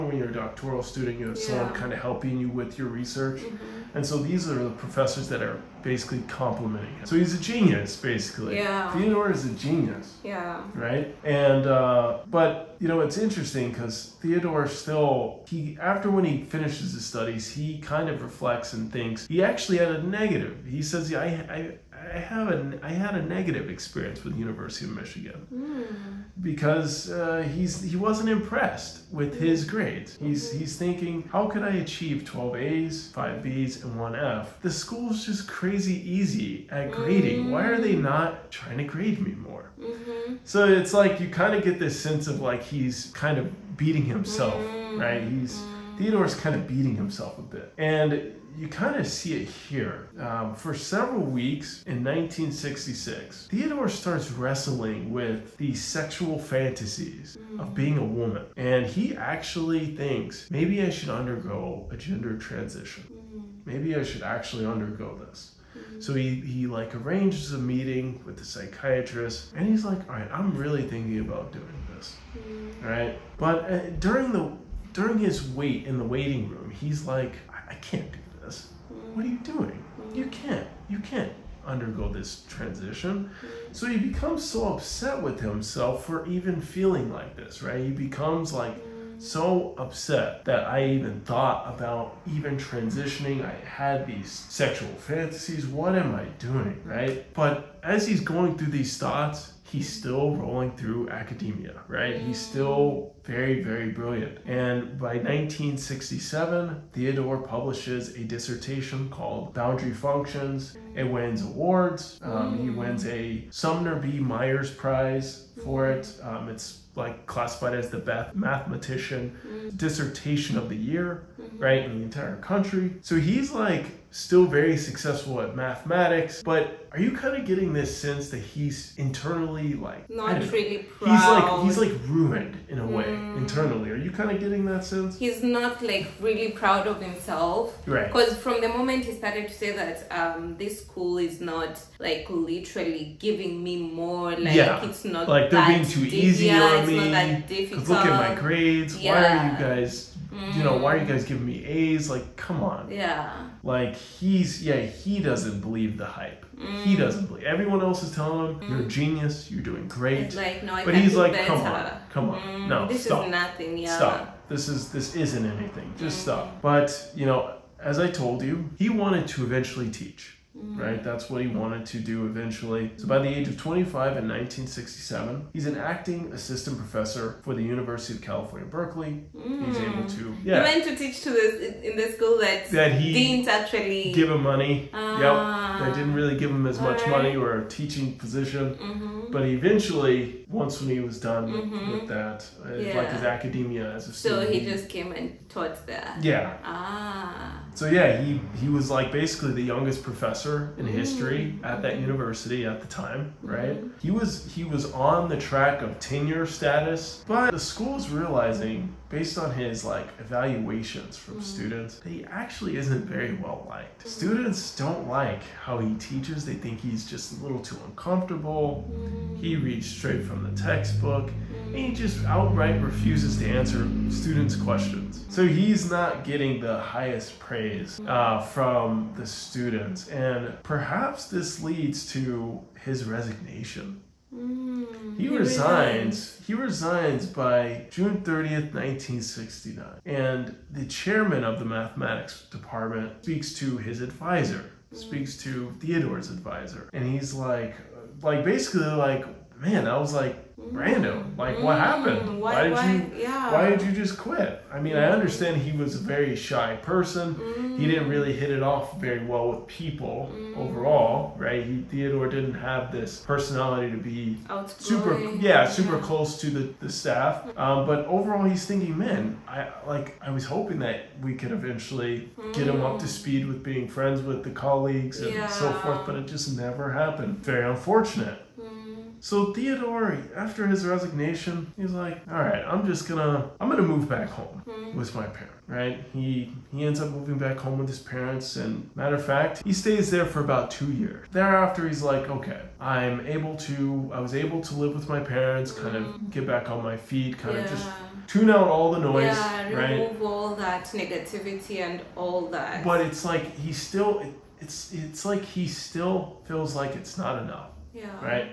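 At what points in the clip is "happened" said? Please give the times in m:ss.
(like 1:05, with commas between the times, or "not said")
4:11, 4:36.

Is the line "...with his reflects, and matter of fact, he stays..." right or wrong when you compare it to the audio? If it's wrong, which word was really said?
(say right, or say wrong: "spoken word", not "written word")
wrong: "parents", not "reflects".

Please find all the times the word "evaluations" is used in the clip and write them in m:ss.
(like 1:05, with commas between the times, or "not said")
3:30.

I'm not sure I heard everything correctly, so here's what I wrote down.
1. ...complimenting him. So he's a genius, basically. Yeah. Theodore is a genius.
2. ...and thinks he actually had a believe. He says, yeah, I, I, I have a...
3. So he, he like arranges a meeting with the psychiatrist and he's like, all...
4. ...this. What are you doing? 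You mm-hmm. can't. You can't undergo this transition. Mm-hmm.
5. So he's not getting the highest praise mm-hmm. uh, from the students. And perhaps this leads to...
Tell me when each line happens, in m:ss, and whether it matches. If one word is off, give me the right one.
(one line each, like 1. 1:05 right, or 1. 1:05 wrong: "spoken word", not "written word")
1. 0:06 right
2. 0:18 wrong: "negative", not "believe"
3. 1:06 right
4. 1:18 right
5. 3:45 right.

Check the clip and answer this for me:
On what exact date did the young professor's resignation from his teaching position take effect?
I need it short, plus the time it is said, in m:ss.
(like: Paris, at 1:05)
June 30th, 1969, at 3:57.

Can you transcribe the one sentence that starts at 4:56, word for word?
get back on my feet, kind yeah.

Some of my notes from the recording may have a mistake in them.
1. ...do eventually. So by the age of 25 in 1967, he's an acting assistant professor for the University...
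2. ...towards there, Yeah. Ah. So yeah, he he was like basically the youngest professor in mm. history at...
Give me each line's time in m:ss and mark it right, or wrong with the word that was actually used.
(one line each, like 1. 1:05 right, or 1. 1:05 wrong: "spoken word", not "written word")
1. 2:51 right
2. 3:15 right.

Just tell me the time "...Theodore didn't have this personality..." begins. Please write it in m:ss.
4:21.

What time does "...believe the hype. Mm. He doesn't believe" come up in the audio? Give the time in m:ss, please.
2:35.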